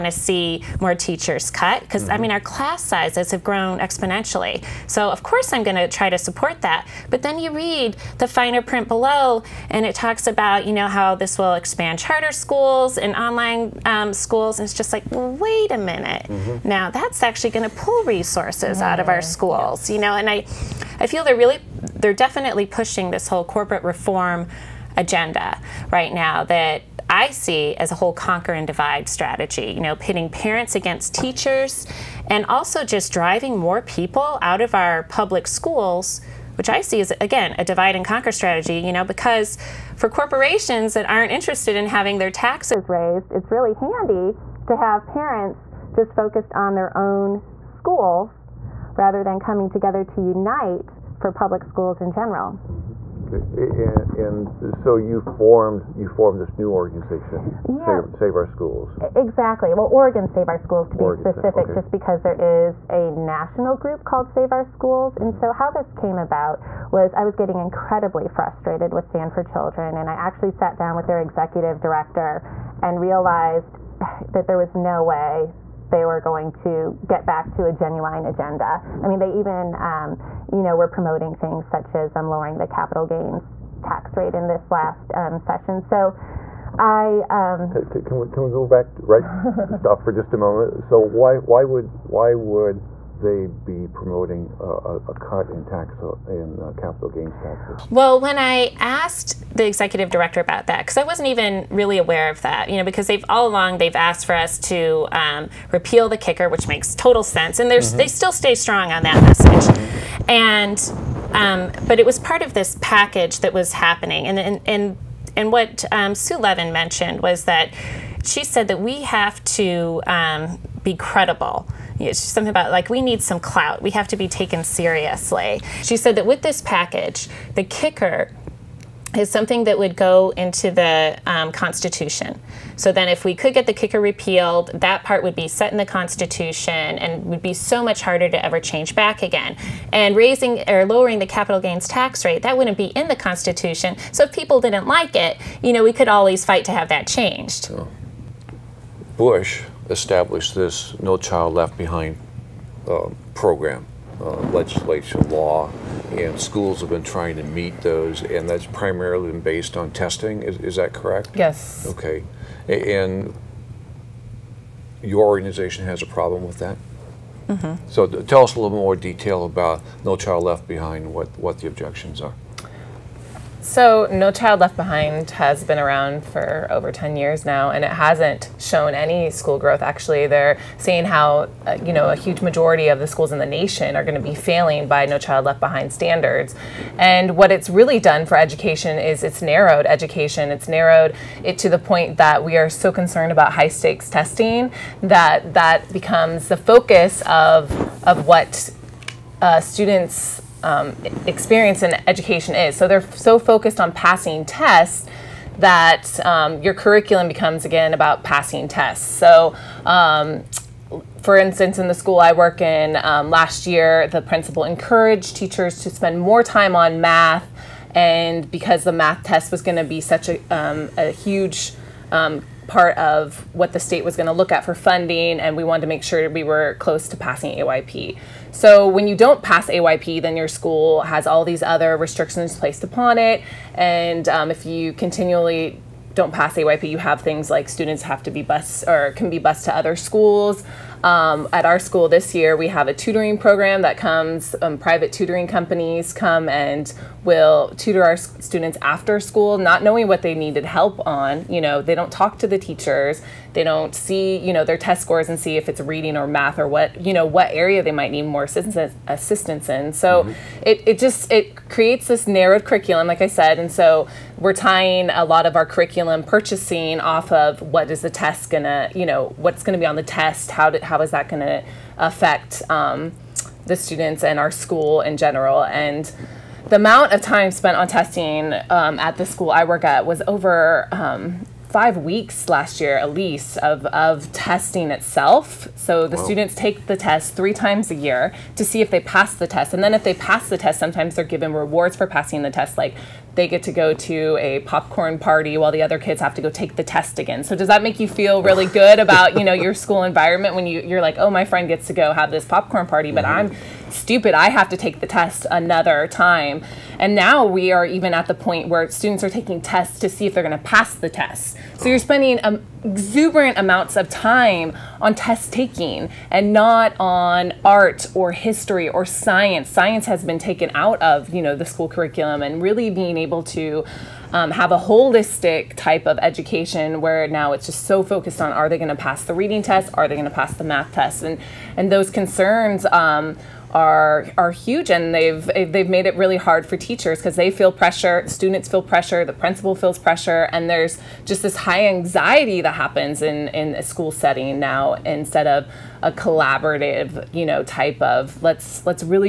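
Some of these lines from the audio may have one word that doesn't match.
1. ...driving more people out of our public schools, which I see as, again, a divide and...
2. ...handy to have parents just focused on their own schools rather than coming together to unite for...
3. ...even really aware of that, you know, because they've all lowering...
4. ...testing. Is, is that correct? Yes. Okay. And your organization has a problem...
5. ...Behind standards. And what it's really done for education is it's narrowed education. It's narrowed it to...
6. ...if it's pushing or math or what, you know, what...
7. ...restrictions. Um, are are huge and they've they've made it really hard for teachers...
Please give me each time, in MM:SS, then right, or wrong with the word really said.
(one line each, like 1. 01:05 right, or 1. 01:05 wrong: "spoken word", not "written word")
1. 00:33 right
2. 00:43 right
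3. 01:41 wrong: "along", not "lowering"
4. 02:39 right
5. 03:05 right
6. 04:15 wrong: "reading", not "pushing"
7. 05:32 wrong: "concerns", not "restrictions".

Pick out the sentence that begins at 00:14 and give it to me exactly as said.
And it's just like, well, wait a minute.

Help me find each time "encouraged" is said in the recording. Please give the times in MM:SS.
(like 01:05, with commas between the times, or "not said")
03:34.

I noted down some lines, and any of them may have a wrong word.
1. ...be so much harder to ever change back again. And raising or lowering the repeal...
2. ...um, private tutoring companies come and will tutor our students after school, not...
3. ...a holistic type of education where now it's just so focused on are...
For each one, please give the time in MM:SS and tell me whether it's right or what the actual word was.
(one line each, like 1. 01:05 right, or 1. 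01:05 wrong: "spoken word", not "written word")
1. 02:17 wrong: "capital", not "repeal"
2. 04:04 right
3. 05:24 right.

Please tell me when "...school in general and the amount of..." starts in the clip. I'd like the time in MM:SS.
04:34.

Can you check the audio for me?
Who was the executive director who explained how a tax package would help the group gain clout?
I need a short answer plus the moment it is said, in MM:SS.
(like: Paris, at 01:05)
Sue Levin, at 01:56.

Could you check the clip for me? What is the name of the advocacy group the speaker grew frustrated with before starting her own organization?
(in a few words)
Stand for Children.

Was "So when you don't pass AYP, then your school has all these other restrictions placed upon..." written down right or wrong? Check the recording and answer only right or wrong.
right.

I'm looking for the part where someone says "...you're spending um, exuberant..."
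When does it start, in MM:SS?
05:11.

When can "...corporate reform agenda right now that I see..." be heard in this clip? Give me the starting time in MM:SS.
00:23.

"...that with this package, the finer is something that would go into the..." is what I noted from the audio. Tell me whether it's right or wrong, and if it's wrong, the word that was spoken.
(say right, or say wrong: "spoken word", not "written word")
wrong: "kicker", not "finer".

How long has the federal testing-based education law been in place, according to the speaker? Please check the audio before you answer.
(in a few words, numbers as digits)
over 10 years.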